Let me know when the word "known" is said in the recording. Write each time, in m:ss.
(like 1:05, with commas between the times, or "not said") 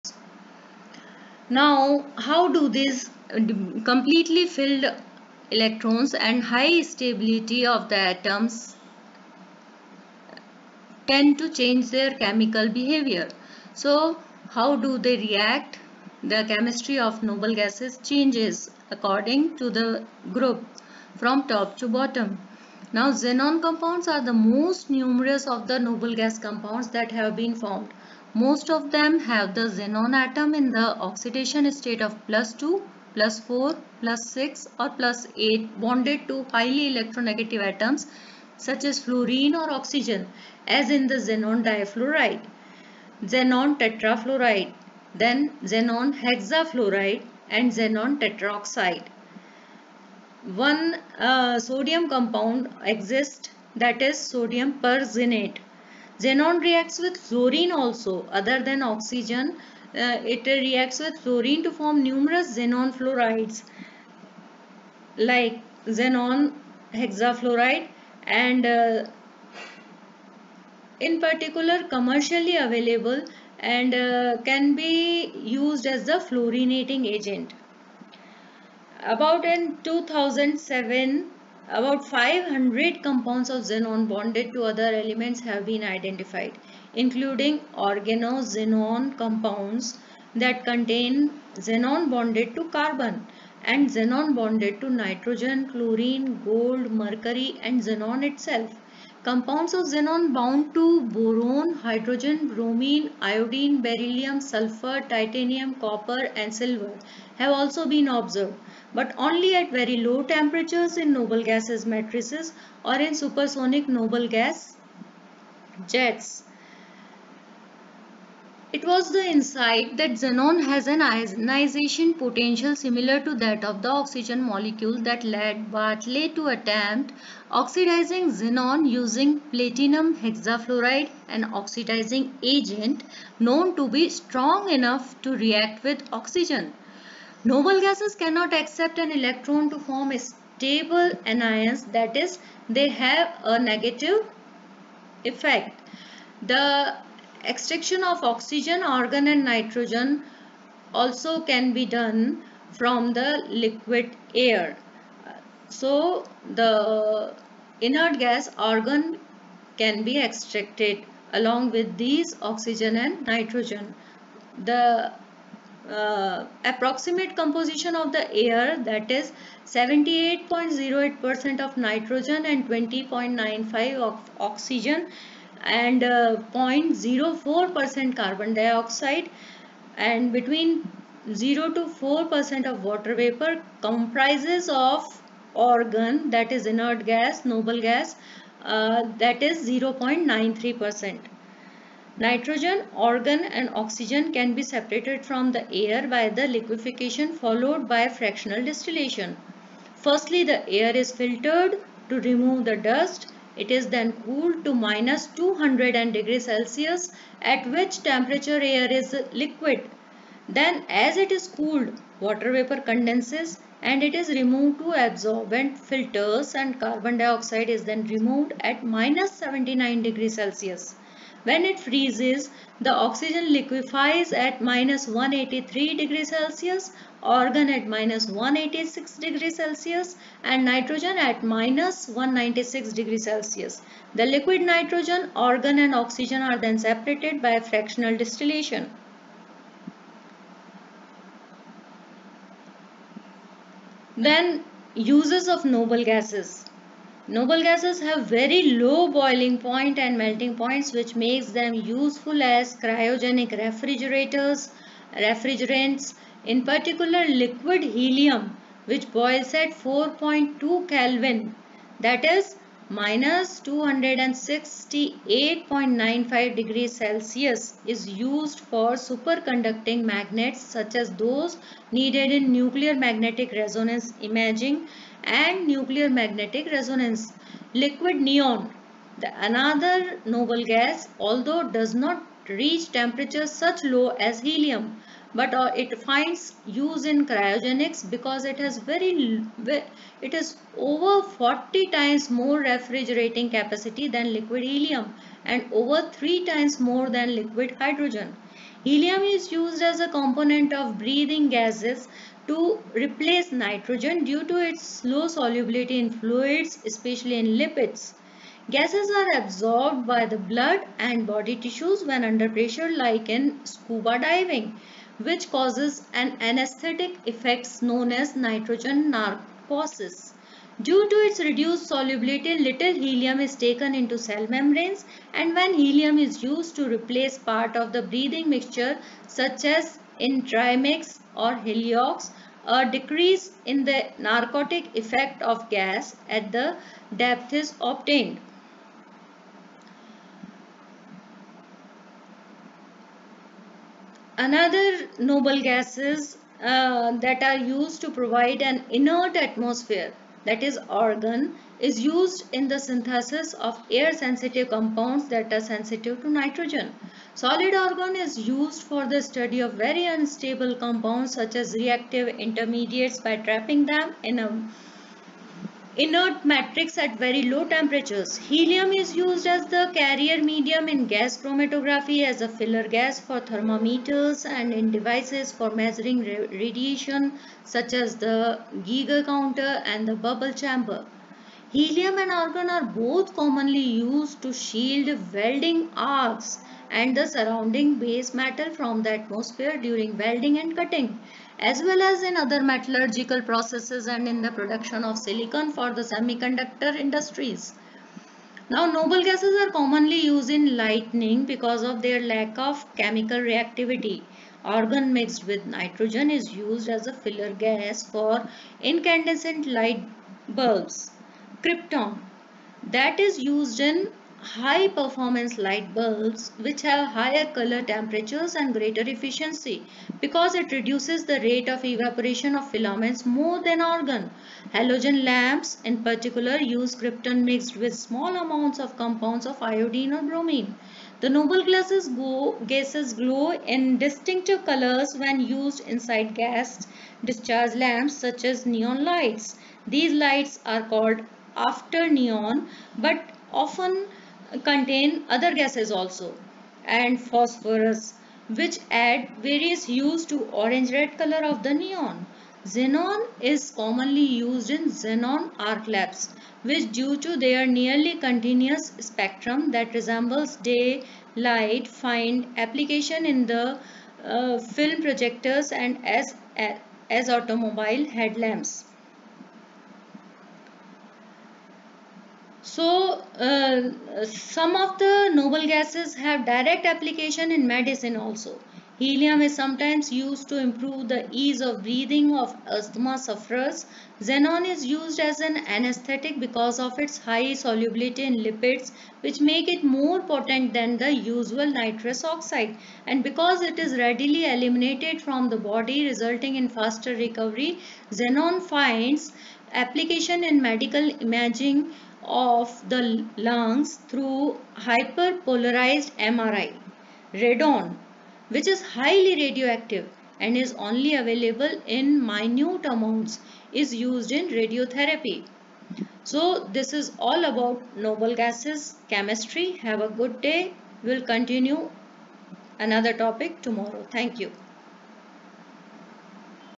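2:13, 5:17.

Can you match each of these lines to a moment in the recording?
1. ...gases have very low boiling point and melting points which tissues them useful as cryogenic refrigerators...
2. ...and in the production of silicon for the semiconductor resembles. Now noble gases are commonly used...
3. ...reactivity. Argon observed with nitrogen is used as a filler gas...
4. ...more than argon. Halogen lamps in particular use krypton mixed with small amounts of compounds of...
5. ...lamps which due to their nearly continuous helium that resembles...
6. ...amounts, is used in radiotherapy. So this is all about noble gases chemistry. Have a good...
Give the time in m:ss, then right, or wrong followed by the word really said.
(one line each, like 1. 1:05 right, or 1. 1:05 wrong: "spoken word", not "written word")
1. 4:07 wrong: "makes", not "tissues"
2. 6:34 wrong: "industries", not "resembles"
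3. 6:43 wrong: "mixed", not "observed"
4. 7:03 right
5. 7:35 wrong: "spectrum", not "helium"
6. 8:32 right.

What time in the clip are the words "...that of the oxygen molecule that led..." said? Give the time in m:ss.
2:03.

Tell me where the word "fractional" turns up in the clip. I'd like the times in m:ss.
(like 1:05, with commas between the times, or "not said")
3:18, 3:57.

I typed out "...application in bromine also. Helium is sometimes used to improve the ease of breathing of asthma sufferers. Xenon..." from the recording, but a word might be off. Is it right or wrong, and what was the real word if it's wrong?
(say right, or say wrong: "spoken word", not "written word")
wrong: "medicine", not "bromine".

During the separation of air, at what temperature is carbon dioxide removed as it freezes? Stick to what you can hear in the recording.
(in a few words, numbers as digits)
-79 °C.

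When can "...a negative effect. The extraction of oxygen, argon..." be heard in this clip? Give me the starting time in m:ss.
2:23.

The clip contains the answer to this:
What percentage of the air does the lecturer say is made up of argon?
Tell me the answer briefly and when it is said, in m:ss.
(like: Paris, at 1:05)
0.93%, at 3:09.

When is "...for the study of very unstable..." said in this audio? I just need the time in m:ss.
5:58.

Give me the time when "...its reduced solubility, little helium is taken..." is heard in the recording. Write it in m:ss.
5:21.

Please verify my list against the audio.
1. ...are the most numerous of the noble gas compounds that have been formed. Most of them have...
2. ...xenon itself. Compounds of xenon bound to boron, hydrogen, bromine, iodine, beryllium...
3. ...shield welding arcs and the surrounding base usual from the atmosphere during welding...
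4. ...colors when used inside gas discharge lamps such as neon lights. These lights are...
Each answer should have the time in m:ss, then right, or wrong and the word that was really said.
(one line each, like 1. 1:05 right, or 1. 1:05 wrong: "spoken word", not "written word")
1. 0:24 right
2. 1:37 right
3. 6:24 wrong: "metal", not "usual"
4. 7:14 right.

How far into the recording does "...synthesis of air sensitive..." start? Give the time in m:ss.
5:52.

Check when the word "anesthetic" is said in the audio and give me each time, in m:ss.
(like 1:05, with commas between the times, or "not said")
5:16, 8:05.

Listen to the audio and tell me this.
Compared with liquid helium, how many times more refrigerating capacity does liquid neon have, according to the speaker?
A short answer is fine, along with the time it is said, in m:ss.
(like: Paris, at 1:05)
over 40 times, at 4:50.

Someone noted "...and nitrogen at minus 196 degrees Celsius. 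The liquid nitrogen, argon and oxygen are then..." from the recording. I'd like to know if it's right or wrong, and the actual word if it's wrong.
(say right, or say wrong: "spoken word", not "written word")
right.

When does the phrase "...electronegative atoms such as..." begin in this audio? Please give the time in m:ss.
0:36.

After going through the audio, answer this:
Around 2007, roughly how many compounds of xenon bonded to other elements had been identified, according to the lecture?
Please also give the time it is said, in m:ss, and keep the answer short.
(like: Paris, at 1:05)
500, at 1:22.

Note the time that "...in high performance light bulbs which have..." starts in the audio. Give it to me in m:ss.
6:53.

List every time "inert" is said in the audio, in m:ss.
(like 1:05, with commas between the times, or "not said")
2:37, 3:06, 5:48, 6:05.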